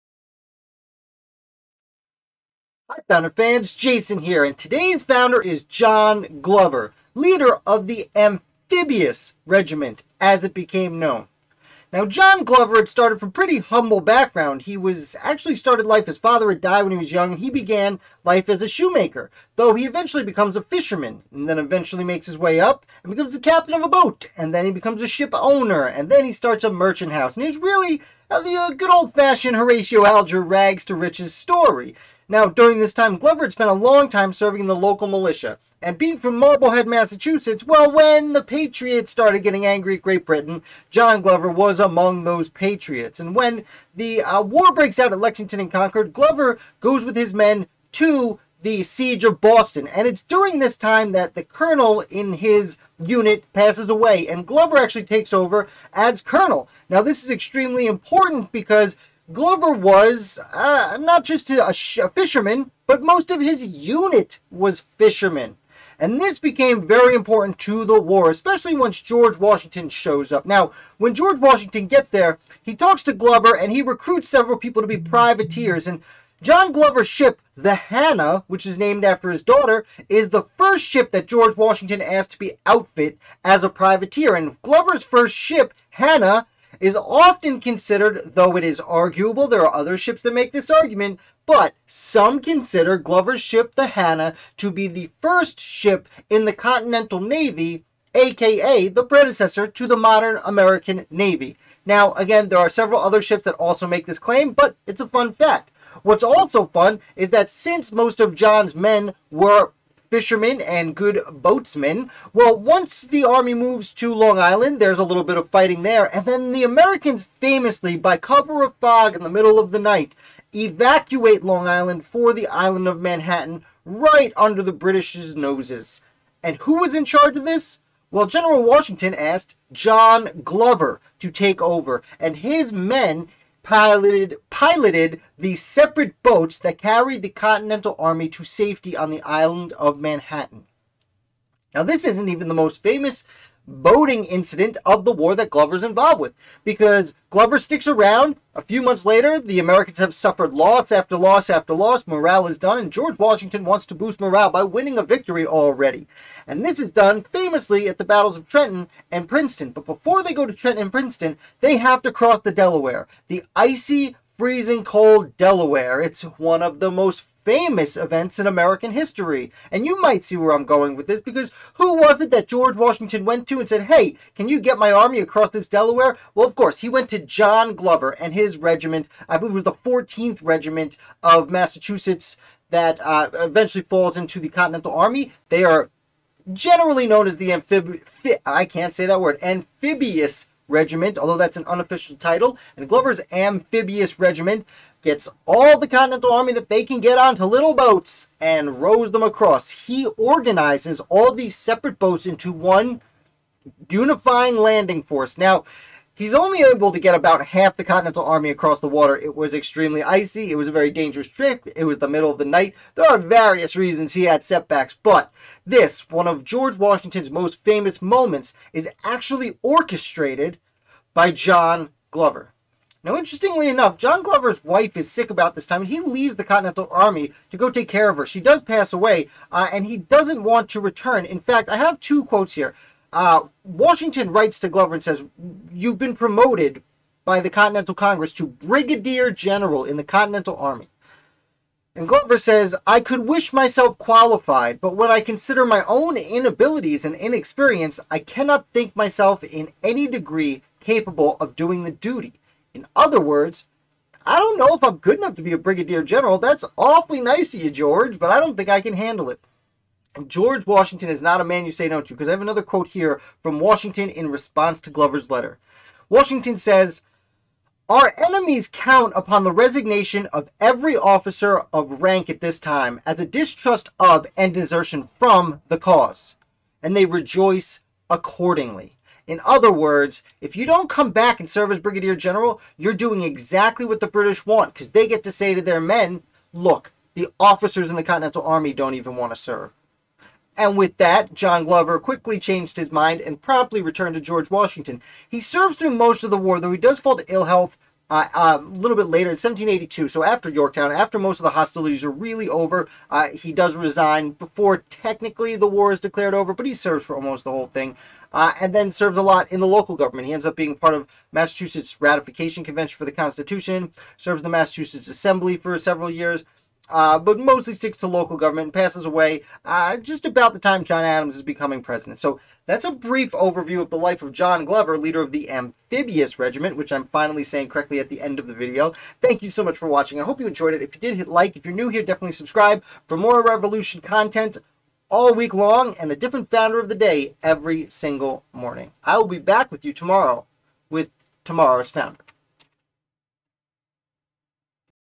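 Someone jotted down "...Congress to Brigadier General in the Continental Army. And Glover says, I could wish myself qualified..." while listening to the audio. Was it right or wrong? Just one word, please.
right.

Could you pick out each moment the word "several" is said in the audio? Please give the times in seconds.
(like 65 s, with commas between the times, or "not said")
74 s, 102 s, 315 s.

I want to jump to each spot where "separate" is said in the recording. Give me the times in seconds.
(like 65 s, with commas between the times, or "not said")
135 s, 201 s.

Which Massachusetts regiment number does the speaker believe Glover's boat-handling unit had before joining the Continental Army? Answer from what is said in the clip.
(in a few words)
14th.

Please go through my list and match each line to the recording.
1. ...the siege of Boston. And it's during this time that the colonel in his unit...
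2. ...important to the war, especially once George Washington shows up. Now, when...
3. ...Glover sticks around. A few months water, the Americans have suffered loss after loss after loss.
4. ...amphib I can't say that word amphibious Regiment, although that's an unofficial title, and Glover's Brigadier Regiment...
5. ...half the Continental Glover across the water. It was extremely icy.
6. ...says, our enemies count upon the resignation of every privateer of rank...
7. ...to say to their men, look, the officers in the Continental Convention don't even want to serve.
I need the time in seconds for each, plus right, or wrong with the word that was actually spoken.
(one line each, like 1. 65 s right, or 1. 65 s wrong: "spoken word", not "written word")
1. 48 s right
2. 67 s right
3. 147 s wrong: "later", not "water"
4. 187 s wrong: "Amphibious", not "Brigadier"
5. 207 s wrong: "Army", not "Glover"
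6. 266 s wrong: "officer", not "privateer"
7. 285 s wrong: "Army", not "Convention".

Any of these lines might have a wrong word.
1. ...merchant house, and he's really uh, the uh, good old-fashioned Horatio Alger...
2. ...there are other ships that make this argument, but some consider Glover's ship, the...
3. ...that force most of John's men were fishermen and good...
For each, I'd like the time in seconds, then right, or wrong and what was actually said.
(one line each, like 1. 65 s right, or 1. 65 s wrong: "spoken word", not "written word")
1. 26 s right
2. 89 s right
3. 107 s wrong: "since", not "force".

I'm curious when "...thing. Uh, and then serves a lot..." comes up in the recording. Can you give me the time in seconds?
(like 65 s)
307 s.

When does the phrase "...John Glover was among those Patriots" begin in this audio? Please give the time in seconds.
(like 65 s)
40 s.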